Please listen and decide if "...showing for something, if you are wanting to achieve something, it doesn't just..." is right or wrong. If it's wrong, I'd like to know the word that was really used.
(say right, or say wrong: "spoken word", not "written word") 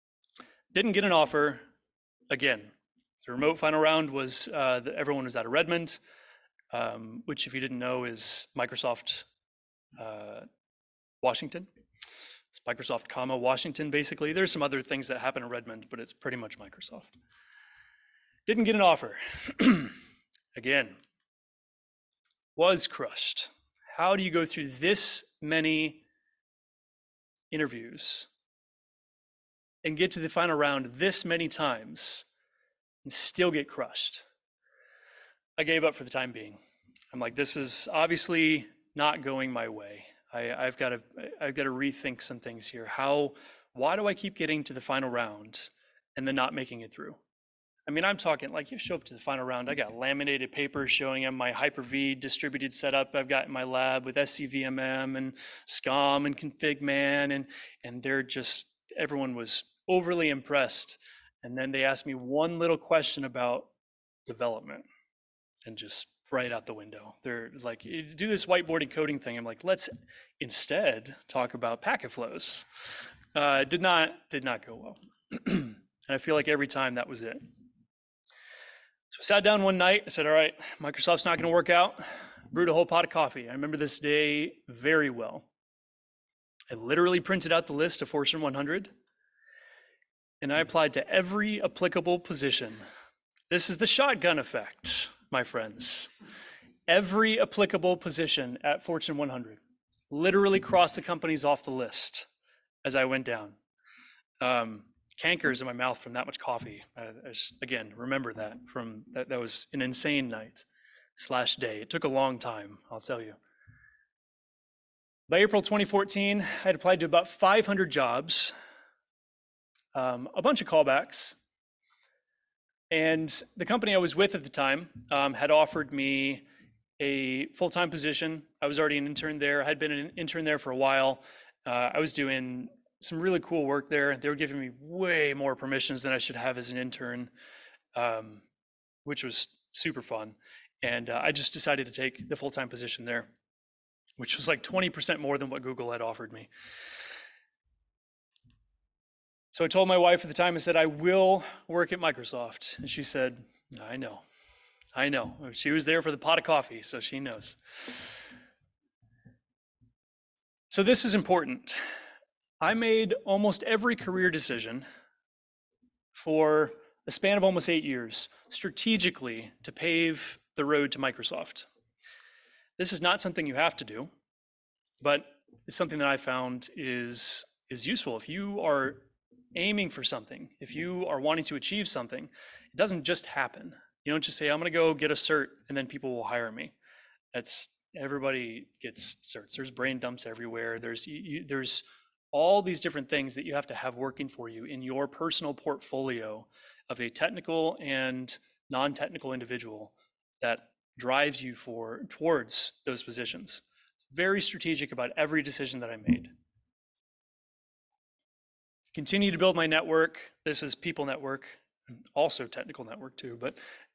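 wrong: "aiming", not "showing".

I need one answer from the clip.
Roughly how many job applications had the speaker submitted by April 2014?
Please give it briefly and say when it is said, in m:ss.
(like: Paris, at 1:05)
500, at 1:57.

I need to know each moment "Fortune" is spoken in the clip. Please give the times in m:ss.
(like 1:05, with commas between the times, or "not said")
1:28, 1:38.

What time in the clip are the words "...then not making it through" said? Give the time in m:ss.
0:46.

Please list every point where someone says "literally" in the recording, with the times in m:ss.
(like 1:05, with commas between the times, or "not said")
1:26, 1:40.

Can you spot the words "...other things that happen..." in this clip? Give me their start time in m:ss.
0:14.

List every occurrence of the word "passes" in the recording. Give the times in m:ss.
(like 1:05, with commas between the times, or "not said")
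not said.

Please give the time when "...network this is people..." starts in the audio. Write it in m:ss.
3:29.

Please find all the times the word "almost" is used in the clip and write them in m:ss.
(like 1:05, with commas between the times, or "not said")
2:43, 2:47.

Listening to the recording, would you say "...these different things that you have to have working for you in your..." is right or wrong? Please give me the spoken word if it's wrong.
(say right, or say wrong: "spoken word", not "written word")
right.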